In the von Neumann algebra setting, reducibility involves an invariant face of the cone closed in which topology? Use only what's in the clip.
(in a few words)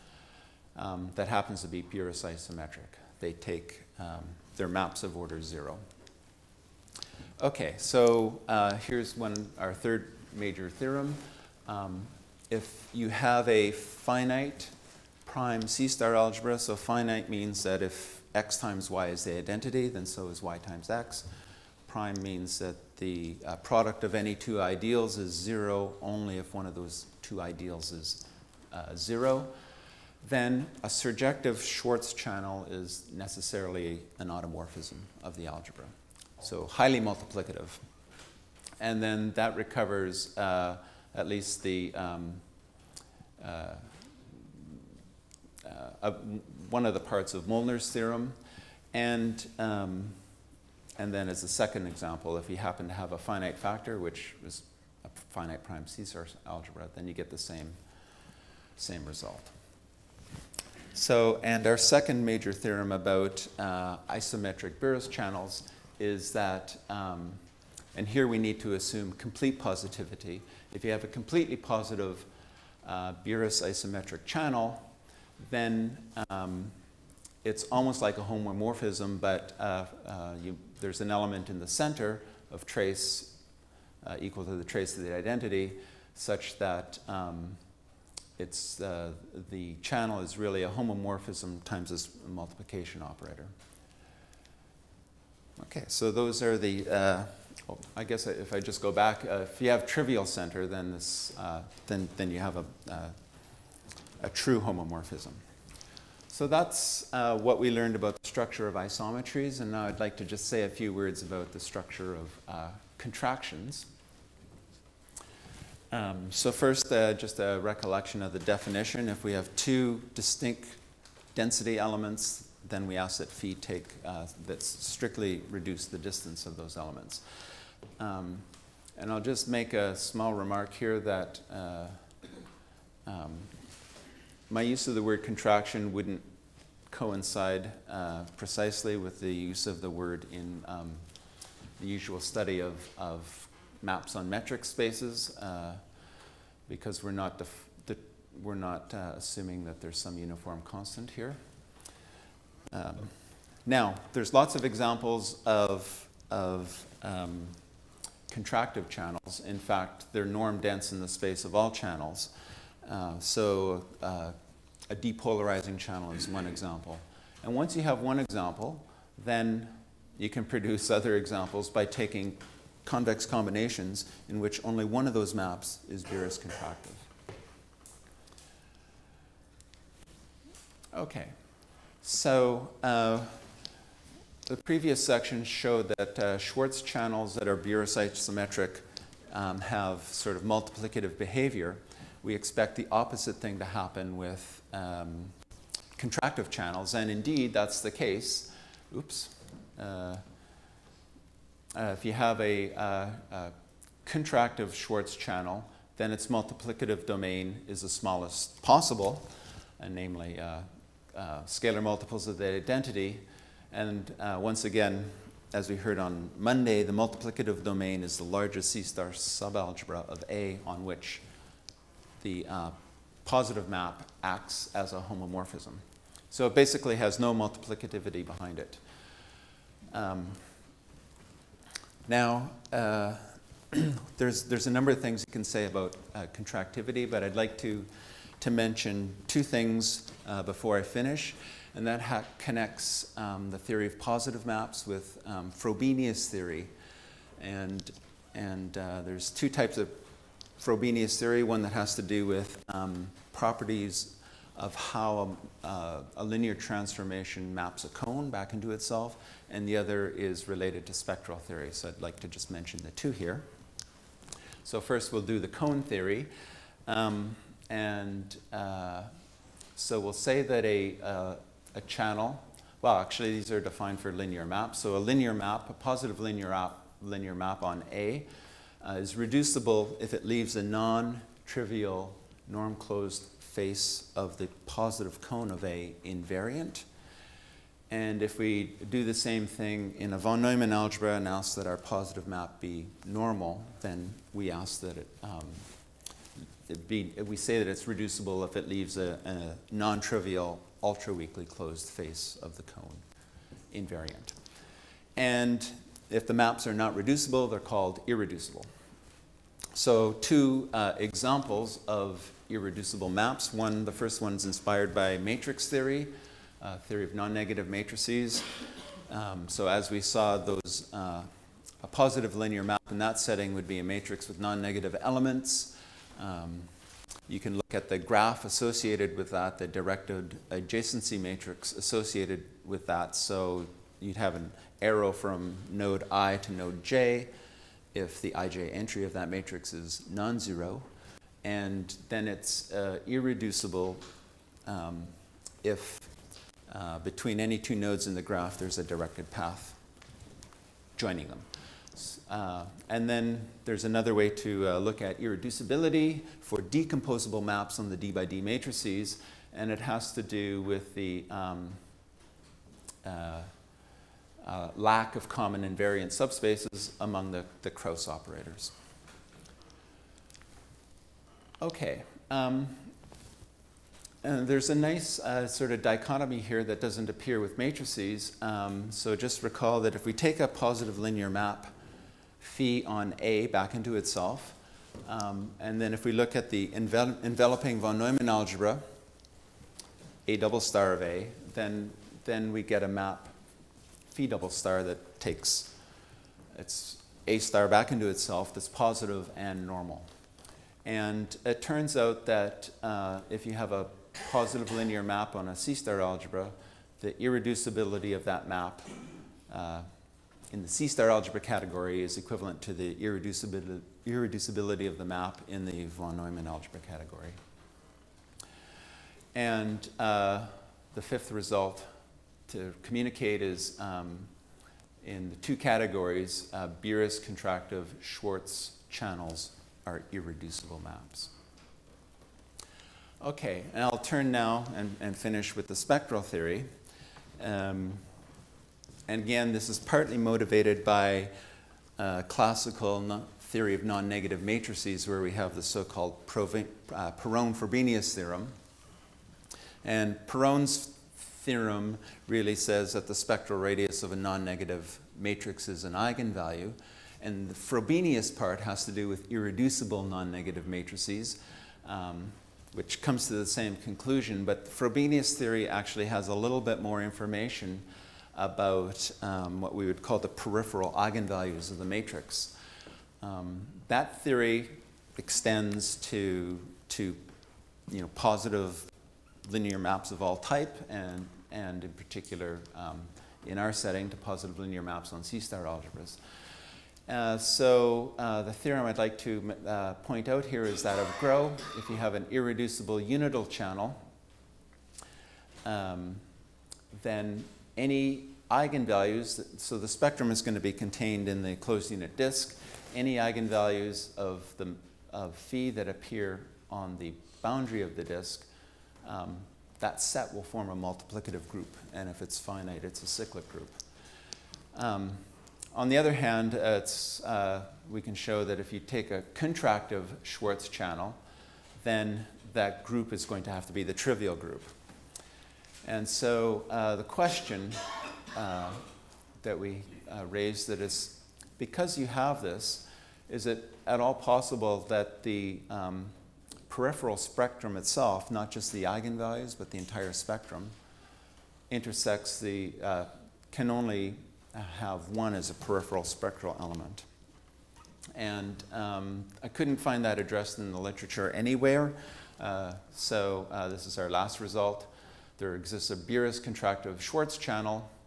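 ultra-weakly closed.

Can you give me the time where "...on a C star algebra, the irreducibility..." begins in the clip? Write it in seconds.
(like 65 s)
405 s.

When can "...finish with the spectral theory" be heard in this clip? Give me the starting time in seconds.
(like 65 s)
435 s.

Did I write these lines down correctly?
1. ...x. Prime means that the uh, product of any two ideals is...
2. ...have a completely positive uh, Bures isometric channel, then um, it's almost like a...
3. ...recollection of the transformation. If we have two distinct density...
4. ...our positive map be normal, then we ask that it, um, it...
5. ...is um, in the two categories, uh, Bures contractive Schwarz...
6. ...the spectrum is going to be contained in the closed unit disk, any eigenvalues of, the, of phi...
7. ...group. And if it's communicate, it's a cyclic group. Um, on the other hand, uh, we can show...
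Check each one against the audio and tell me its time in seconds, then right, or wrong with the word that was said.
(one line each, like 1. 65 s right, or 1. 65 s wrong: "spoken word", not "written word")
1. 20 s right
2. 70 s right
3. 117 s wrong: "definition", not "transformation"
4. 291 s right
5. 423 s right
6. 499 s right
7. 511 s wrong: "finite", not "communicate".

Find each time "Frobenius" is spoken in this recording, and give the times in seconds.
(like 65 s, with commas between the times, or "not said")
245 s, 250 s, 447 s, 457 s, 464 s.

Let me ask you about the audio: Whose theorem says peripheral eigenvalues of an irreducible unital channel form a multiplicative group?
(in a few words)
Groh.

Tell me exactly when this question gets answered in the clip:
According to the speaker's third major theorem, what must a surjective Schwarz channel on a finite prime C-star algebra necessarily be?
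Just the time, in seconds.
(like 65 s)
34 s.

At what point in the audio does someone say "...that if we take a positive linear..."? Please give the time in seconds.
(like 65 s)
379 s.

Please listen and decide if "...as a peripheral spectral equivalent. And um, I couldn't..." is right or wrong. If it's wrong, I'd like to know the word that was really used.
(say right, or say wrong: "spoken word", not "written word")
wrong: "element", not "equivalent".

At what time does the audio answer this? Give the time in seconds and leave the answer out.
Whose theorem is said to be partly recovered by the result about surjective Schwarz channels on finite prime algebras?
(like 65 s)
47 s.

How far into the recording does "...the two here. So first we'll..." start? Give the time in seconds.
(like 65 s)
262 s.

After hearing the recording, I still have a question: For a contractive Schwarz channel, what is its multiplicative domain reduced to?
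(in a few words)
scalar multiples of the identity.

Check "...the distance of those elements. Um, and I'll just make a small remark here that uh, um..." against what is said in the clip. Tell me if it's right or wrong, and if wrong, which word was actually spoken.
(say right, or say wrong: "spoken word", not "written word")
right.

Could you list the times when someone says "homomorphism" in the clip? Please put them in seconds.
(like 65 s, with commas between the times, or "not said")
78 s, 90 s, 104 s, 224 s.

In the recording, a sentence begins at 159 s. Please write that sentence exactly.
In fact, they're norm dense in the space of all channels.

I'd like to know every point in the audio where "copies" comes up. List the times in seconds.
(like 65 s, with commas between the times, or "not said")
not said.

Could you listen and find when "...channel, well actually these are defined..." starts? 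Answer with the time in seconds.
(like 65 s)
271 s.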